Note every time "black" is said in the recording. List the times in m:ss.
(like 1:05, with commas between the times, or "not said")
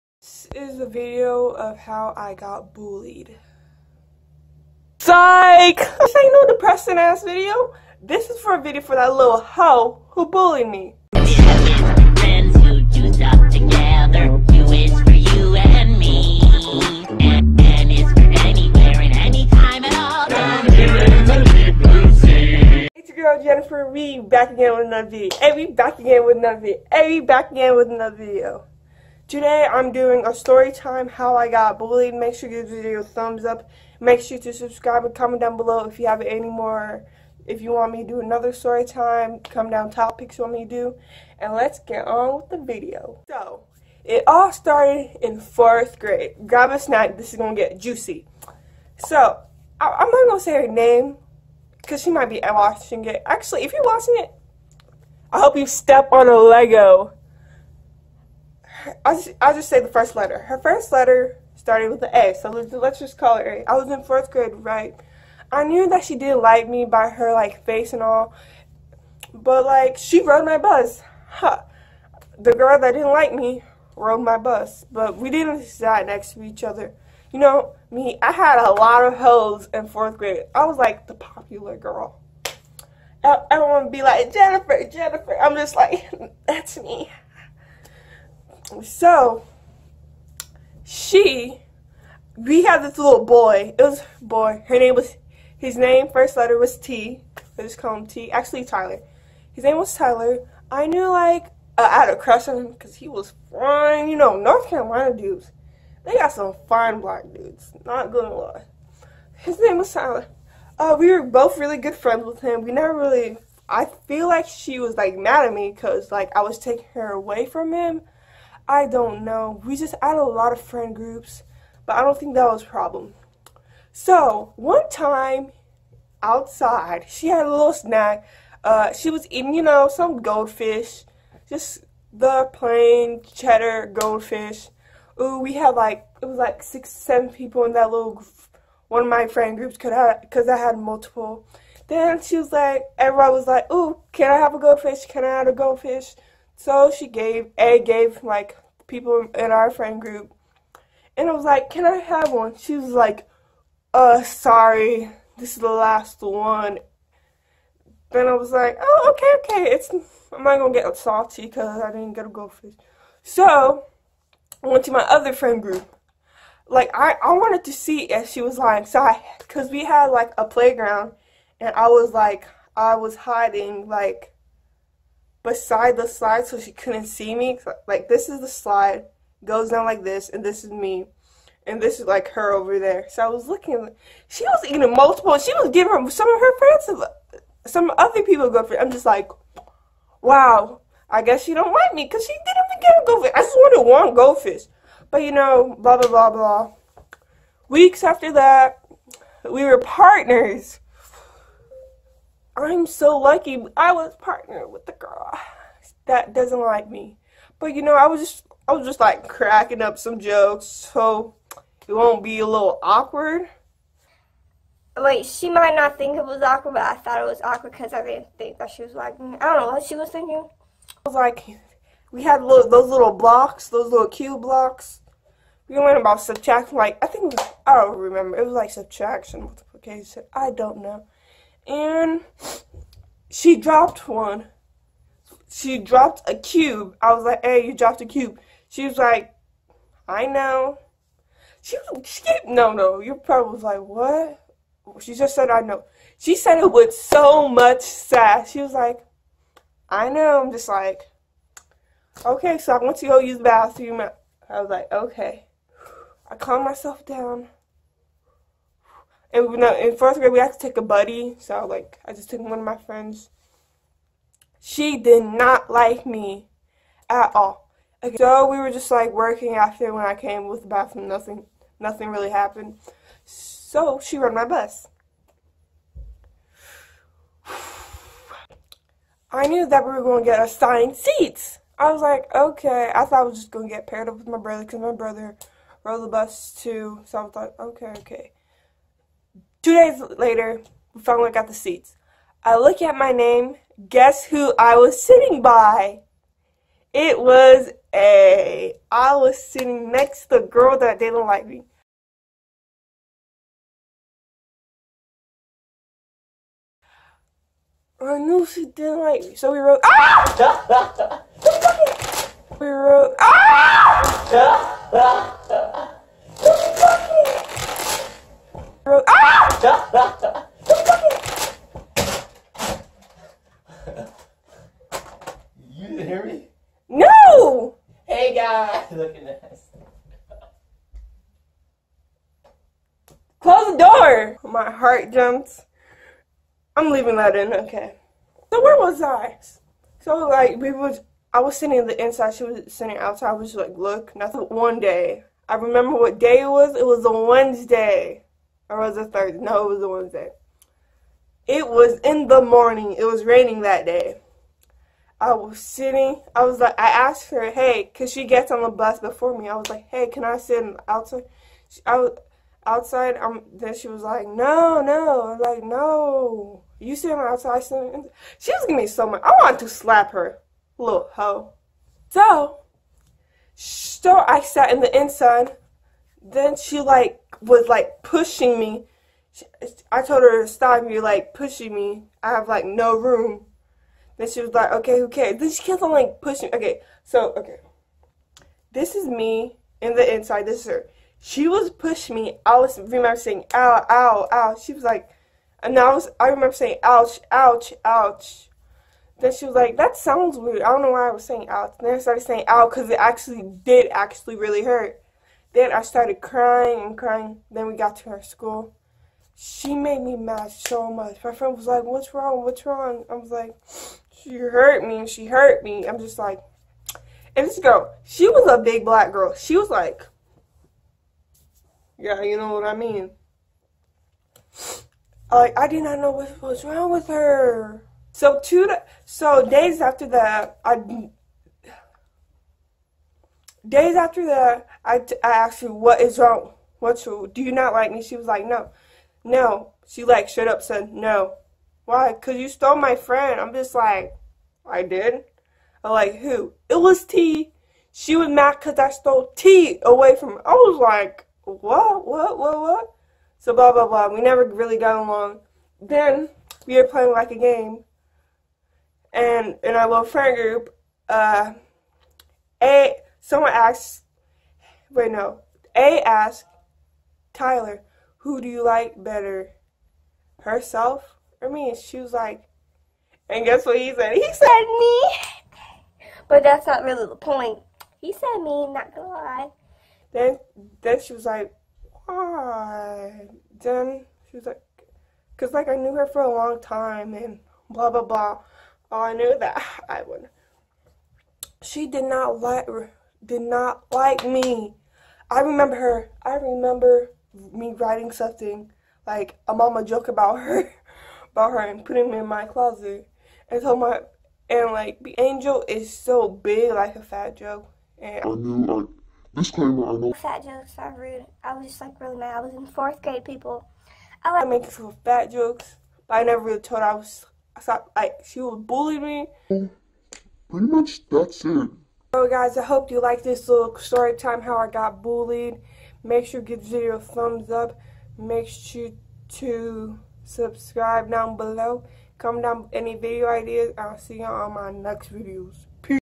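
1:47, 6:58.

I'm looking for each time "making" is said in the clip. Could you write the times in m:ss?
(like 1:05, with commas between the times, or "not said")
8:34.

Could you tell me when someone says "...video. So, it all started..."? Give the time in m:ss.
0:42.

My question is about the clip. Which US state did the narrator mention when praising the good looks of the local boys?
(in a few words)
North Carolina.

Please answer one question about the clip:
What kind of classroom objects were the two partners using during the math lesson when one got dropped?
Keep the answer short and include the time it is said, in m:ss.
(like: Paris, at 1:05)
Cube blocks, at 3:44.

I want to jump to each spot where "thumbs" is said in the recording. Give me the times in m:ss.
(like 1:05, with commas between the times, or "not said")
0:33, 8:46.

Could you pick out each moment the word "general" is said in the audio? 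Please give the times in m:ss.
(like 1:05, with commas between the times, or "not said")
not said.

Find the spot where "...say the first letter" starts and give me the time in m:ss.
0:59.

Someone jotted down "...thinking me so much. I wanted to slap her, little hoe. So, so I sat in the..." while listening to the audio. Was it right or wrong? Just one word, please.
wrong.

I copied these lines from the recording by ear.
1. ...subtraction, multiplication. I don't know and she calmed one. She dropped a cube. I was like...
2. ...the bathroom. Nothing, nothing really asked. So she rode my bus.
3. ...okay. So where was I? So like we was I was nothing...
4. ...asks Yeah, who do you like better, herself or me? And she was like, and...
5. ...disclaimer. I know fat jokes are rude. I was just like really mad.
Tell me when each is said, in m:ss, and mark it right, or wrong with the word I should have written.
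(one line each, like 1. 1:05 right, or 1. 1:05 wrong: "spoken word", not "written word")
1. 3:48 wrong: "dropped", not "calmed"
2. 4:30 wrong: "happened", not "asked"
3. 5:37 wrong: "sitting", not "nothing"
4. 7:46 wrong: "Tyler", not "Yeah"
5. 8:29 right.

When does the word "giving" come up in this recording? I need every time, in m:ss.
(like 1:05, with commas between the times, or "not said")
3:05, 6:08.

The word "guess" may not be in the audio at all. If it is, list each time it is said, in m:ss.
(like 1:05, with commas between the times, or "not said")
3:11, 4:53, 7:53.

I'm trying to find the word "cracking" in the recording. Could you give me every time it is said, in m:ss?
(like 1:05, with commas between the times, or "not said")
3:29.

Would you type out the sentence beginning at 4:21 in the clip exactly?
So, like, I just took one of my friends.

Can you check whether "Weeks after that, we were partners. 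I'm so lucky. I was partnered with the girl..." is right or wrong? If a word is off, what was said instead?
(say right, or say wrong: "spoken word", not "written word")
right.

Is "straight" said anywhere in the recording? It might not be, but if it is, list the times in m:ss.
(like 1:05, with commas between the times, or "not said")
not said.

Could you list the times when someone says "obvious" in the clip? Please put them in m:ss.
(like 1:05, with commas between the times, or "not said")
not said.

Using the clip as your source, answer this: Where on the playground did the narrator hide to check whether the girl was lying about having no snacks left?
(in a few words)
Beside the slide.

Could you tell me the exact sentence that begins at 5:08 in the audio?
I knew she didn't like me, so we wrote.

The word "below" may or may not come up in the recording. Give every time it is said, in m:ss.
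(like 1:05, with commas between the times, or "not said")
0:35, 8:51.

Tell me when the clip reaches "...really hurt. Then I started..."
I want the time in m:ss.
6:44.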